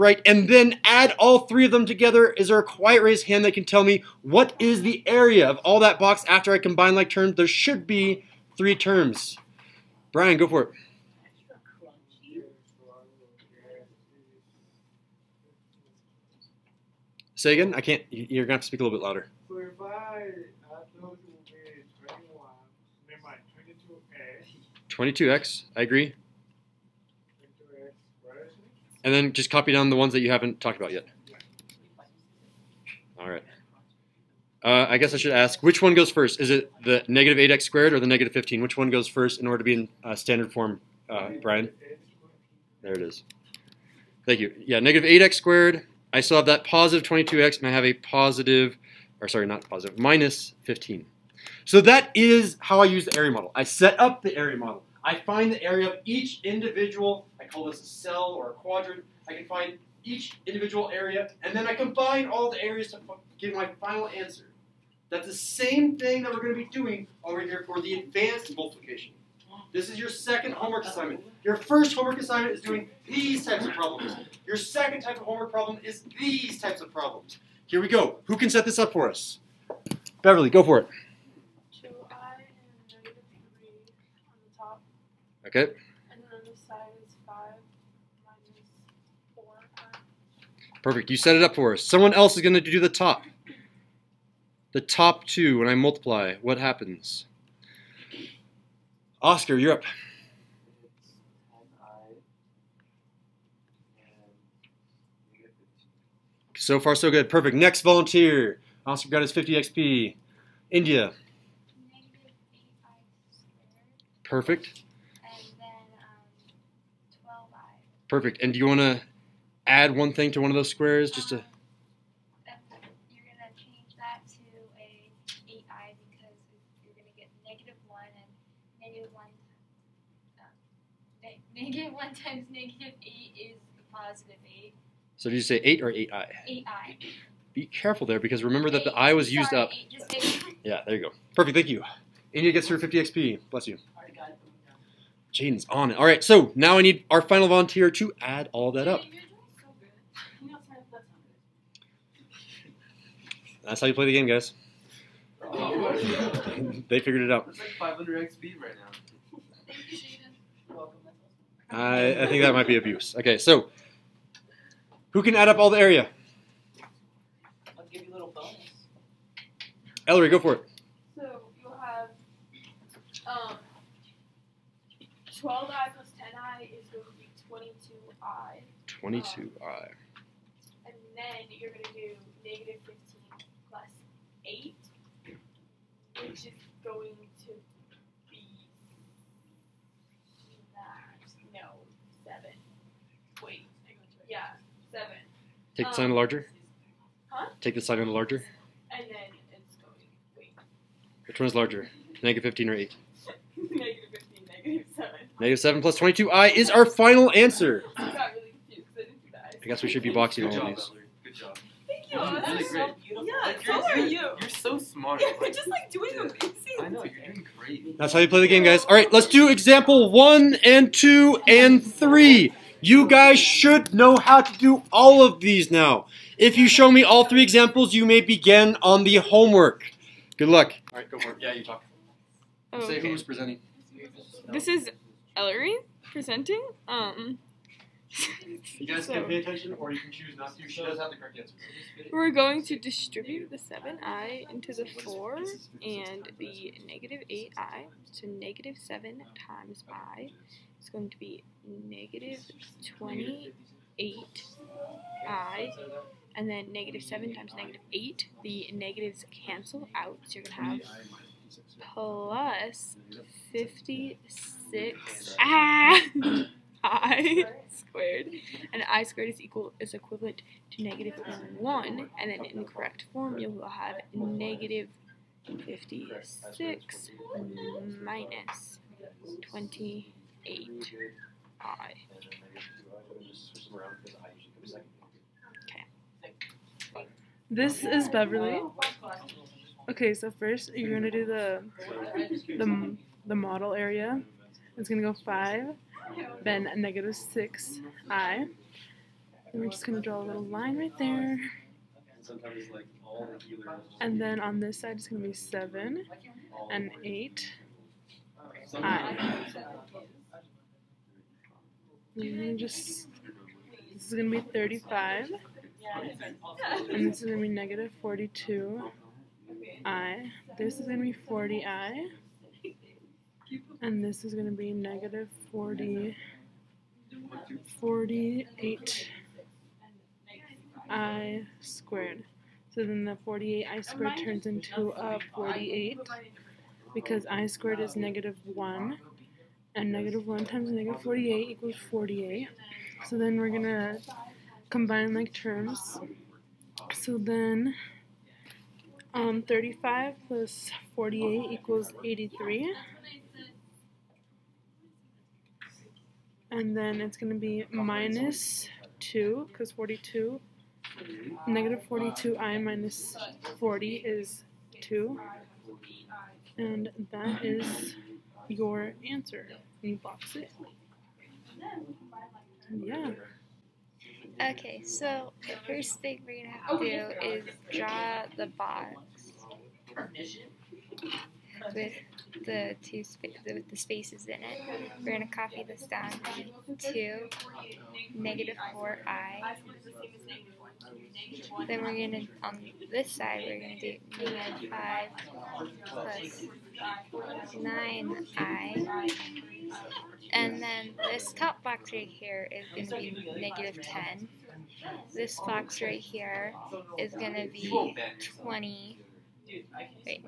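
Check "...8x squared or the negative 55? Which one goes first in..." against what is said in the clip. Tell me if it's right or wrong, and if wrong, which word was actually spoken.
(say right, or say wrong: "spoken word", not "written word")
wrong: "15", not "55".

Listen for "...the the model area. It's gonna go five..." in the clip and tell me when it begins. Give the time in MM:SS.
04:52.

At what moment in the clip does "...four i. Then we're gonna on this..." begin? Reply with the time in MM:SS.
06:28.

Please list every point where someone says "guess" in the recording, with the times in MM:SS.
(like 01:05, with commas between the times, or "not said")
00:34, 03:29.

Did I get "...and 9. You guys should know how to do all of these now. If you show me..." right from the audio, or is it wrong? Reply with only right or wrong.
wrong.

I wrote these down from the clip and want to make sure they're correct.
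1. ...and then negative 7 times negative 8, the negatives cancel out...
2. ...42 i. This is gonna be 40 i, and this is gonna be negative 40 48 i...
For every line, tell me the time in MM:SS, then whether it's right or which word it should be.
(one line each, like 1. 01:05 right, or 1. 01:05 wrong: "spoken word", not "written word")
1. 04:16 right
2. 05:18 right.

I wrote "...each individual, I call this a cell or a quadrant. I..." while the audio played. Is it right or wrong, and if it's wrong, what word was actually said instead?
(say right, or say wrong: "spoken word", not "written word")
right.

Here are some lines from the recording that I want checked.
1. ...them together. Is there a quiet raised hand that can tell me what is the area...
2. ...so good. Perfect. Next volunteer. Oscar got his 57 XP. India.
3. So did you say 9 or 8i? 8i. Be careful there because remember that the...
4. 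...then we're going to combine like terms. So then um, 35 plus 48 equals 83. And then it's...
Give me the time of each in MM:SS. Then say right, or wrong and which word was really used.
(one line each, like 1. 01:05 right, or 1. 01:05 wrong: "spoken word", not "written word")
1. 00:01 right
2. 01:46 wrong: "50", not "57"
3. 02:15 wrong: "8", not "9"
4. 05:43 right.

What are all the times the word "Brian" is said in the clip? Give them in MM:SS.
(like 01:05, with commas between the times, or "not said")
00:10, 00:41.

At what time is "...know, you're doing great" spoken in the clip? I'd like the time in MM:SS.
03:36.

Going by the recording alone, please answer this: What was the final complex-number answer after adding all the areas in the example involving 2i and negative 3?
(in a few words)
-7 + 22i.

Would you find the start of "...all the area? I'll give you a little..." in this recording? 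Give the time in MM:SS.
02:45.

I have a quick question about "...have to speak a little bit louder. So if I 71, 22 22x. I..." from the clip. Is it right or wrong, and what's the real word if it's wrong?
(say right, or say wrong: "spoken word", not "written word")
wrong: "21", not "71".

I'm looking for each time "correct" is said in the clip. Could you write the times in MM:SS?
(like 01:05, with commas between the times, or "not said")
04:01, 04:32.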